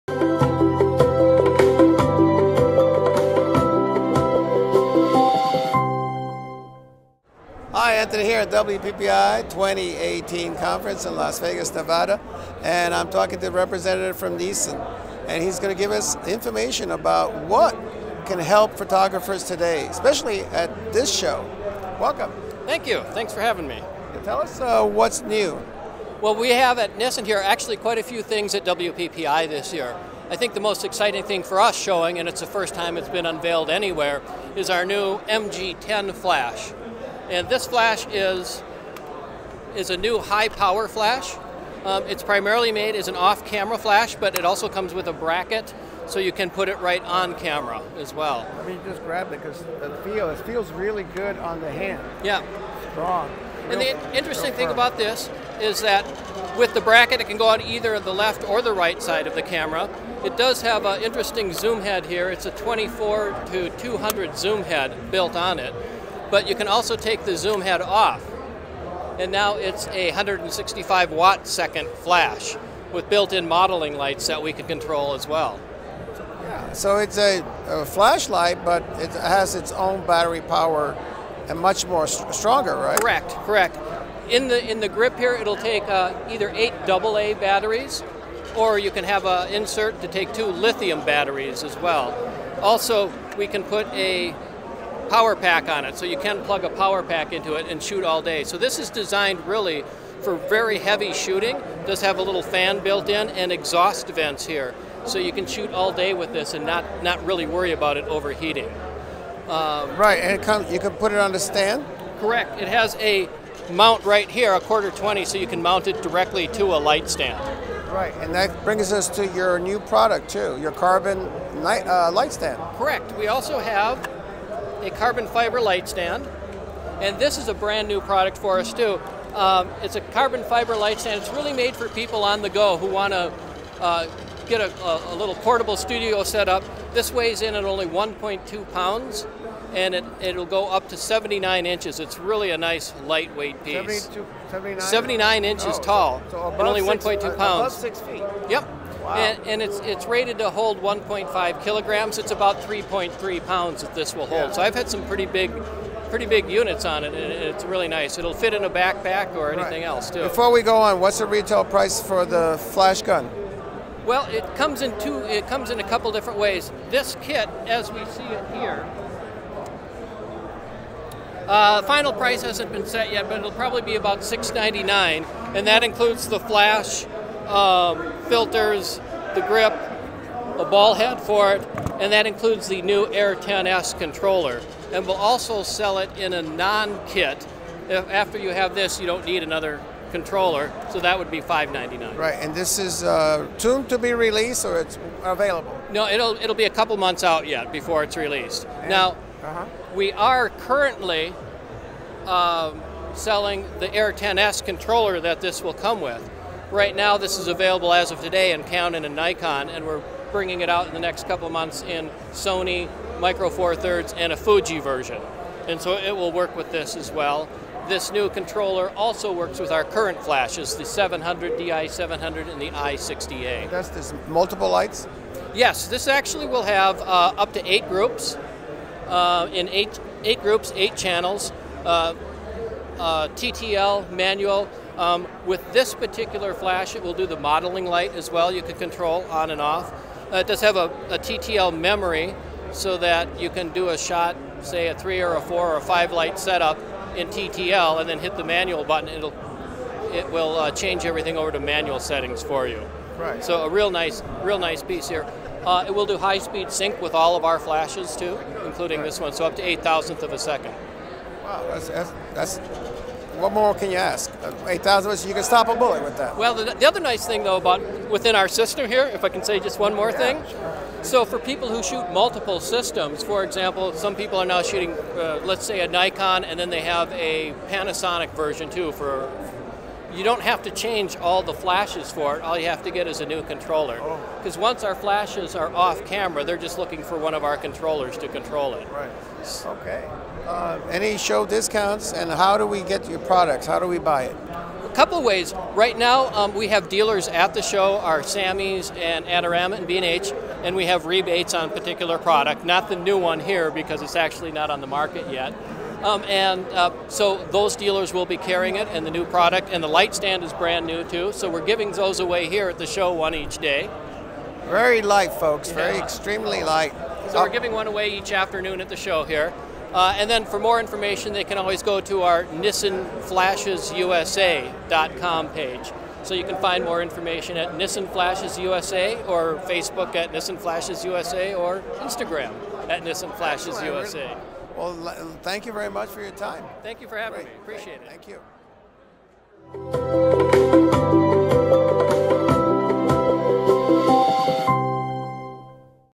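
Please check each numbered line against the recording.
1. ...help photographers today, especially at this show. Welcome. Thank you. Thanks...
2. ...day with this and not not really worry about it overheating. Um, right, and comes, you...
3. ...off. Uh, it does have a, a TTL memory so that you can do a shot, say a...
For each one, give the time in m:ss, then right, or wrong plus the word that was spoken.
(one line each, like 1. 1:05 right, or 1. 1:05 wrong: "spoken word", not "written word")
1. 0:18 right
2. 1:45 right
3. 3:59 right.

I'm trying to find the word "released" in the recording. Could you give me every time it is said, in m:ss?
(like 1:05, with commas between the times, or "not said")
3:14, 3:18.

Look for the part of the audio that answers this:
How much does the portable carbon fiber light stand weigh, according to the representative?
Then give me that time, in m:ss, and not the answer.
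2:17.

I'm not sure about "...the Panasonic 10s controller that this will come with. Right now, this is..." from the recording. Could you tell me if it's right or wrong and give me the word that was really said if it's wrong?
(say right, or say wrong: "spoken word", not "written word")
wrong: "Air", not "Panasonic".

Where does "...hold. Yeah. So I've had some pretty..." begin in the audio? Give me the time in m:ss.
2:34.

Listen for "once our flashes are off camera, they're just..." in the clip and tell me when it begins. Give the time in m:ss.
4:44.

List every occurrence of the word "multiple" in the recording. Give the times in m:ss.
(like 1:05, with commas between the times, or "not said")
3:44, 4:32.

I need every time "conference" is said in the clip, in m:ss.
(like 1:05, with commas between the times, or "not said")
0:10.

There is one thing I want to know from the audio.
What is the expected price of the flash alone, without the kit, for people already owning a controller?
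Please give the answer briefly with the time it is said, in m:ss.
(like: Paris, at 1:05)
$5.99, at 3:11.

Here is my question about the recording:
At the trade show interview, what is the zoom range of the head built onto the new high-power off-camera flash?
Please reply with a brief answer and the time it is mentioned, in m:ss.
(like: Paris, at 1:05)
24 to 200, at 1:02.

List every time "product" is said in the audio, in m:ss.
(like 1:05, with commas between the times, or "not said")
1:59, 2:08, 4:53, 5:02, 5:09.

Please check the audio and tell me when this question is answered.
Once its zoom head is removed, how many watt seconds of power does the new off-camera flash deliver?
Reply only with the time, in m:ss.
1:10.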